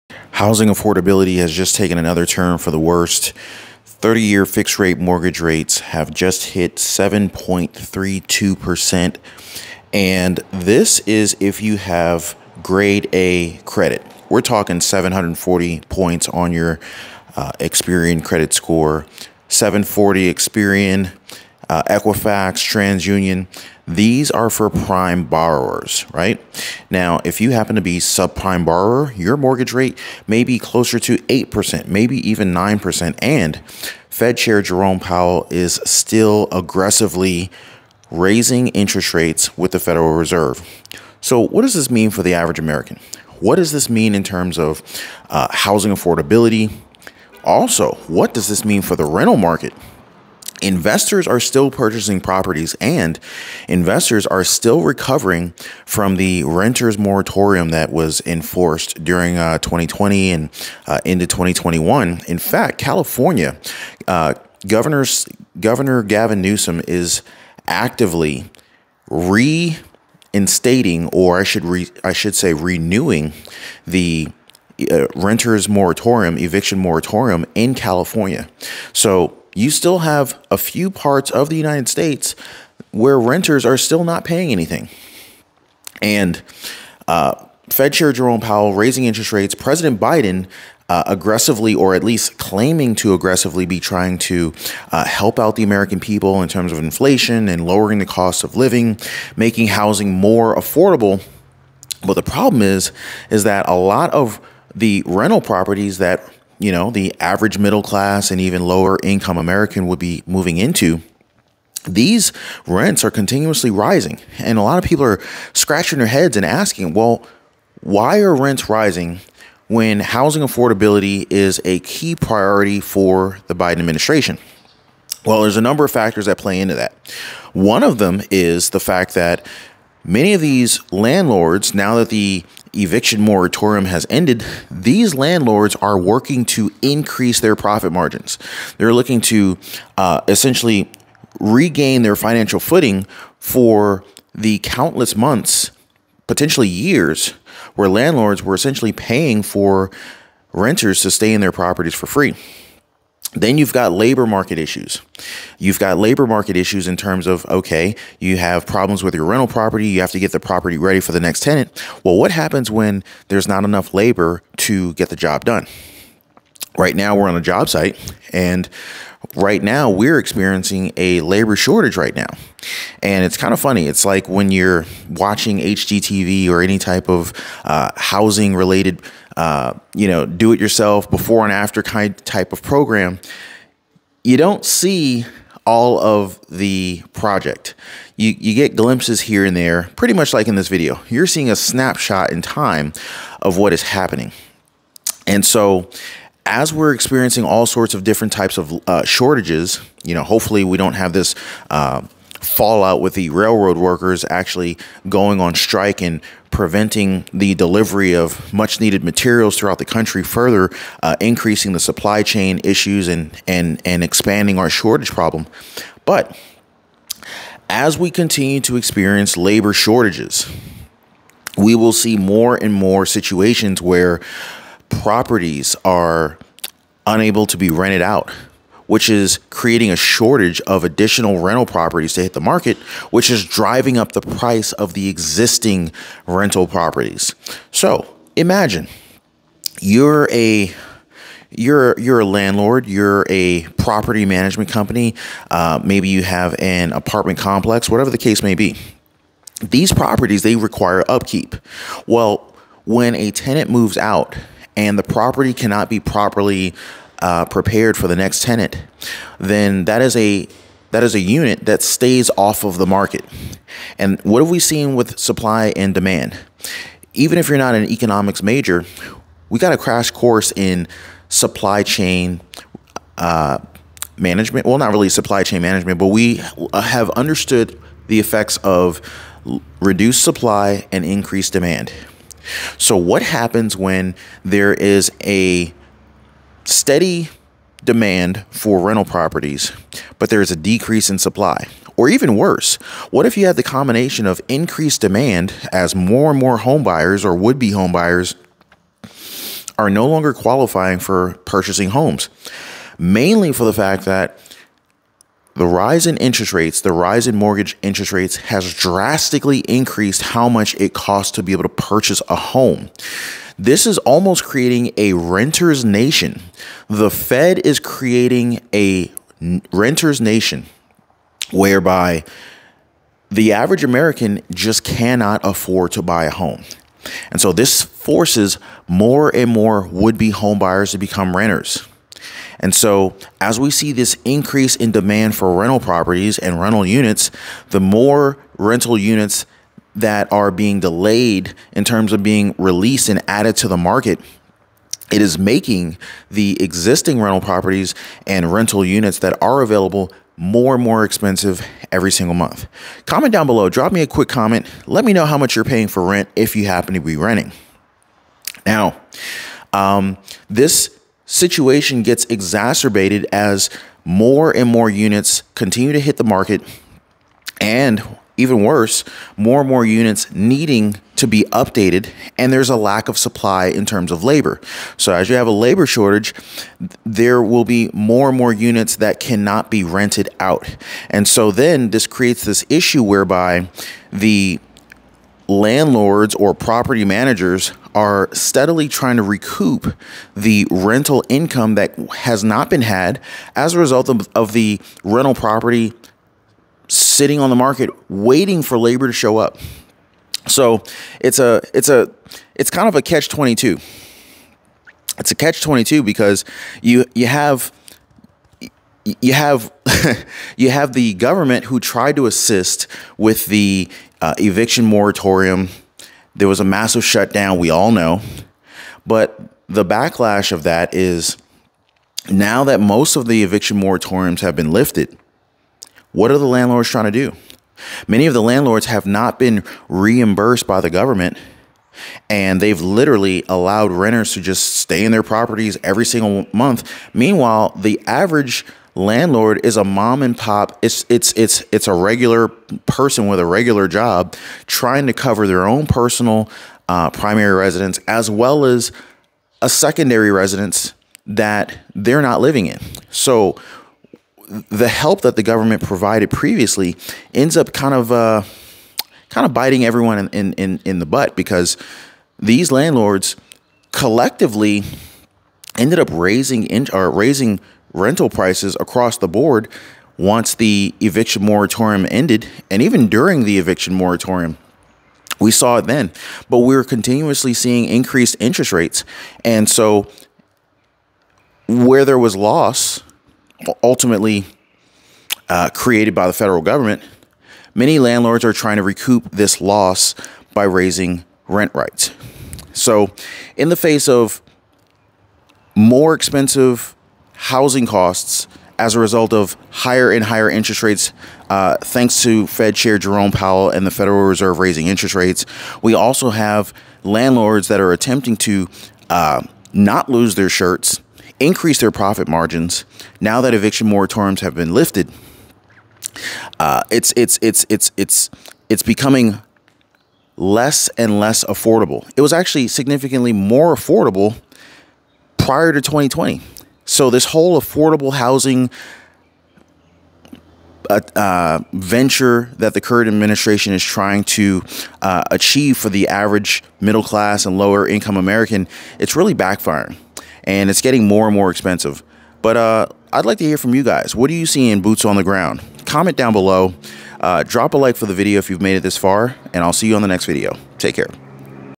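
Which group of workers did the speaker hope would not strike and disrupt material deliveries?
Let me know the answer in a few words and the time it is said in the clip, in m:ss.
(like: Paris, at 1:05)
railroad workers, at 3:23.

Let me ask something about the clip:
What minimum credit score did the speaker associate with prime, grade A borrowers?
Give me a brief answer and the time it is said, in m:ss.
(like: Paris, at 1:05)
740, at 0:14.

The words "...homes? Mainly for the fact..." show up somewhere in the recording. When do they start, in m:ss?
5:01.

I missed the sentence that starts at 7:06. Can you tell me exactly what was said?
What are the landlords trying to do?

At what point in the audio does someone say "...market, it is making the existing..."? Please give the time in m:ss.
5:43.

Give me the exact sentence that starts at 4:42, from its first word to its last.
So, what happens when there is a steady demand for rental properties, but there is a decrease in supply?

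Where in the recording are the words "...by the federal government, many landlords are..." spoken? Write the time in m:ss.
8:06.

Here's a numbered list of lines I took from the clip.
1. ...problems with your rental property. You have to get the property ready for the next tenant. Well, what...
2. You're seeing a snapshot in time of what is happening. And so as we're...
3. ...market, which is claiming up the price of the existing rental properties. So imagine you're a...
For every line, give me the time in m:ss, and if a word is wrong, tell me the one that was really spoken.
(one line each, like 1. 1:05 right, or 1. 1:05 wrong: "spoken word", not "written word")
1. 2:38 right
2. 3:11 right
3. 3:52 wrong: "driving", not "claiming".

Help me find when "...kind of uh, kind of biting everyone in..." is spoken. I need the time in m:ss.
7:37.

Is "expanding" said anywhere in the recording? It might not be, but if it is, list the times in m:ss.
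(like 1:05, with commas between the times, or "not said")
3:34.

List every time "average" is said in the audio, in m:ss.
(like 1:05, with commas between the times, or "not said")
0:42, 1:47, 5:23, 7:18, 8:56.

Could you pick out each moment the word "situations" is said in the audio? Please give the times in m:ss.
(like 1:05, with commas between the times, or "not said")
3:43, 6:01.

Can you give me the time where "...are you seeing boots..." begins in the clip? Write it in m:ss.
9:04.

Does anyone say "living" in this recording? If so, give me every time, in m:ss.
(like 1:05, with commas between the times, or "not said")
1:38, 7:32.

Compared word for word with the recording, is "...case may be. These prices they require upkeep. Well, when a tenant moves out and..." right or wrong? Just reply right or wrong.
wrong.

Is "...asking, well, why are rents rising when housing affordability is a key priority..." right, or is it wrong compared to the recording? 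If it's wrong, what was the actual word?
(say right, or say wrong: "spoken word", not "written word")
right.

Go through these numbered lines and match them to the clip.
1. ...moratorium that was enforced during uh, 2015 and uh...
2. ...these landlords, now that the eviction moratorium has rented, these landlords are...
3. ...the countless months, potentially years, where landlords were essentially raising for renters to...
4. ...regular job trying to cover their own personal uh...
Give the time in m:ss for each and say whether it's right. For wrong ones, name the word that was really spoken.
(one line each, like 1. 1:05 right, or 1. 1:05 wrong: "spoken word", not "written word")
1. 0:56 wrong: "2020", not "2015"
2. 2:10 wrong: "ended", not "rented"
3. 2:24 wrong: "paying", not "raising"
4. 7:23 right.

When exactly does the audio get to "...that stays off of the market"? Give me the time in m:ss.
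4:21.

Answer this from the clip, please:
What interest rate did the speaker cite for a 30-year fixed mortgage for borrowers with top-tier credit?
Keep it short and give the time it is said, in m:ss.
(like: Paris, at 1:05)
7.32%, at 0:06.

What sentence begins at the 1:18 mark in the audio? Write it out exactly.
So you still have a few parts of the United States where renters are still not paying anything.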